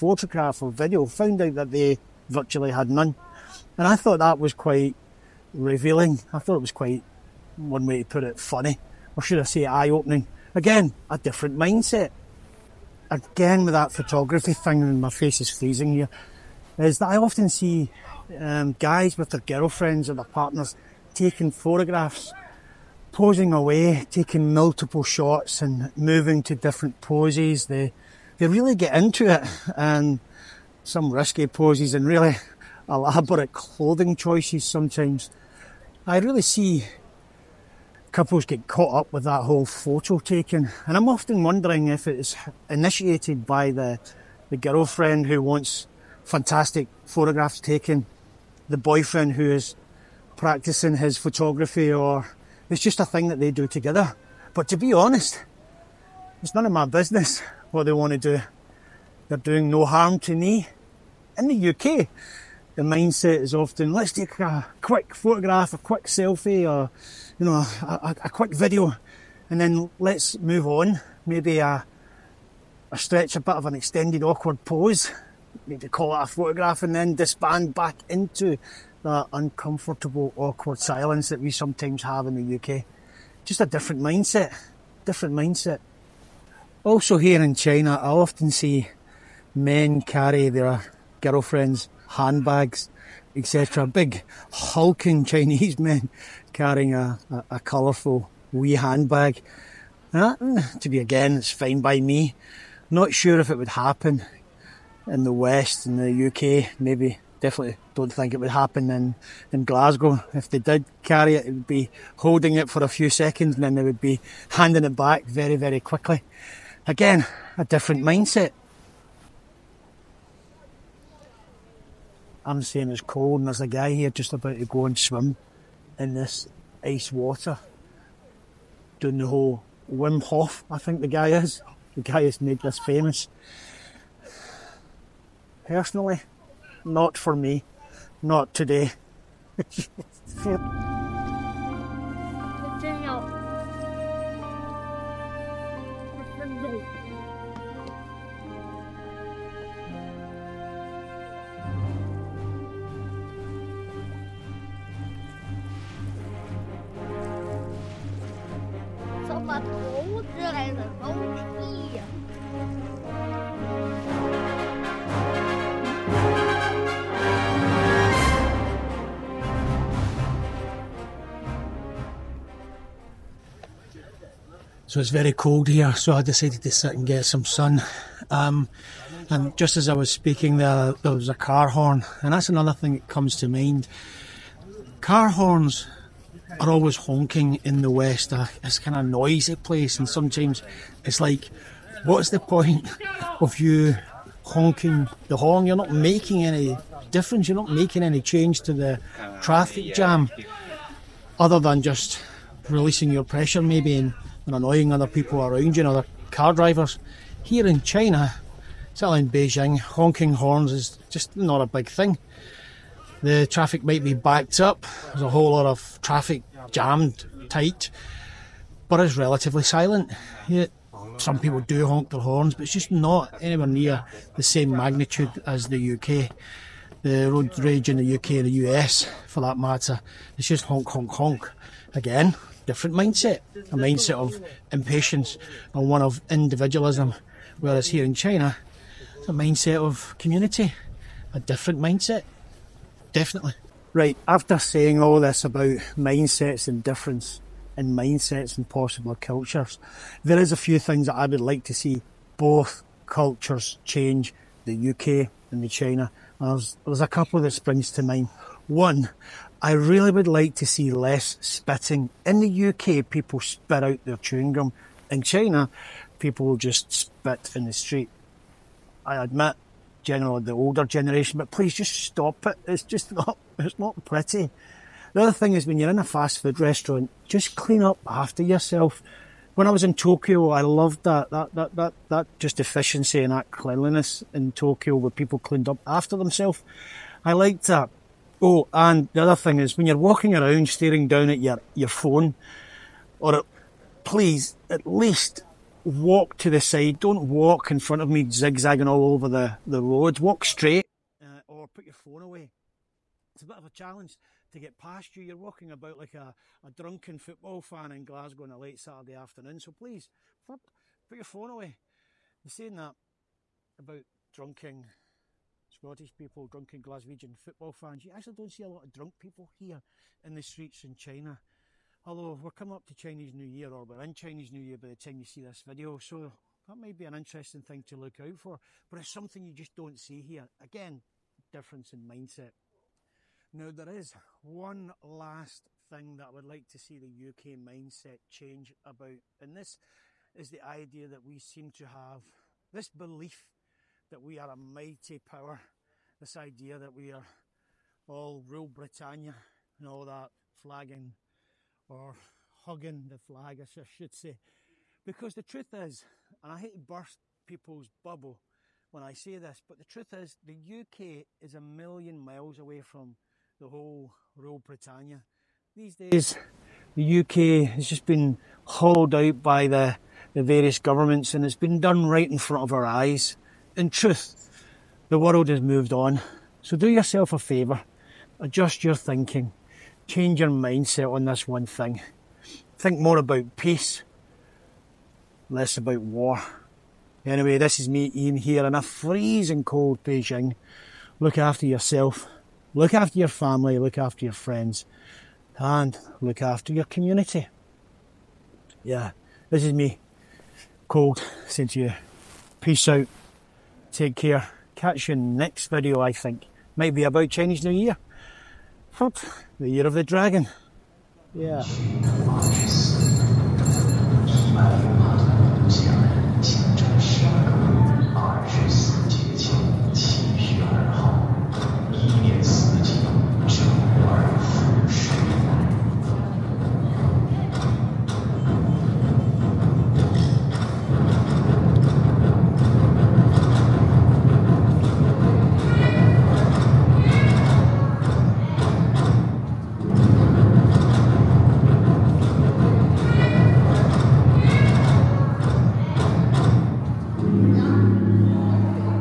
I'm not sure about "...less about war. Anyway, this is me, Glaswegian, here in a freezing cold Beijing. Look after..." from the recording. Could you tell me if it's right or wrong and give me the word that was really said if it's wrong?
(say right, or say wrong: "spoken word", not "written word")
wrong: "Iain", not "Glaswegian".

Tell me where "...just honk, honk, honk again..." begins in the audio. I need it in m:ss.
3:50.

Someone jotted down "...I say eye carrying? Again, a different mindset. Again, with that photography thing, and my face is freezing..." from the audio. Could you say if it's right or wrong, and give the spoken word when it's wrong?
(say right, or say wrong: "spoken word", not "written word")
wrong: "opening", not "carrying".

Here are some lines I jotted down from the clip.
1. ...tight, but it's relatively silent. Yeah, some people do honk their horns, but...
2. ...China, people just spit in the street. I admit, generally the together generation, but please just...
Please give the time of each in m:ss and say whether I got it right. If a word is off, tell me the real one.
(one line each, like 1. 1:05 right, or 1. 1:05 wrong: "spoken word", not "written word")
1. 3:37 right
2. 4:25 wrong: "older", not "together".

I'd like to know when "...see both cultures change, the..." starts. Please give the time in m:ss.
4:11.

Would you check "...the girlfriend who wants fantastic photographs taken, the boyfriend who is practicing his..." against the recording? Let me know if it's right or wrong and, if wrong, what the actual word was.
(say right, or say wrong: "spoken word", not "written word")
right.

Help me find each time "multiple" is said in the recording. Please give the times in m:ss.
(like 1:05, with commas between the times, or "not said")
0:24.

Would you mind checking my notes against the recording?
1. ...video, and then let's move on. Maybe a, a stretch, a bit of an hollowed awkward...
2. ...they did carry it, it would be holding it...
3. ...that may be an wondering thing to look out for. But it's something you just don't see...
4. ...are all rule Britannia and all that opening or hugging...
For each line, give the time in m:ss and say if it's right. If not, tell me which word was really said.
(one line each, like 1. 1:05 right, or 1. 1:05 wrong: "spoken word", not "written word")
1. 1:08 wrong: "extended", not "hollowed"
2. 1:50 right
3. 5:26 wrong: "interesting", not "wondering"
4. 5:47 wrong: "flagging", not "opening".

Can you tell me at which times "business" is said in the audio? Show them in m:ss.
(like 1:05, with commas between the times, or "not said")
0:56.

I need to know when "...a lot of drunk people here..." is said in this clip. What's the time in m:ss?
5:18.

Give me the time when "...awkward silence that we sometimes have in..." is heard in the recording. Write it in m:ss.
1:20.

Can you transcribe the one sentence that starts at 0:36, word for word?
I really see couples get caught up with that whole photo taking.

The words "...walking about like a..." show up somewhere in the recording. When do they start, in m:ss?
5:05.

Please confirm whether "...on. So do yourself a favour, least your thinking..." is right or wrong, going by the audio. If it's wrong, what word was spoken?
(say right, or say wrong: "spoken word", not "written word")
wrong: "adjust", not "least".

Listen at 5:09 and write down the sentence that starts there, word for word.
So please, put your phone away.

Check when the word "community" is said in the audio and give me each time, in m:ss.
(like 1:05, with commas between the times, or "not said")
4:00, 6:36.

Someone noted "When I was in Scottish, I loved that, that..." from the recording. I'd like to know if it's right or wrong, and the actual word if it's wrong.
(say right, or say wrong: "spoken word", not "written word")
wrong: "Tokyo", not "Scottish".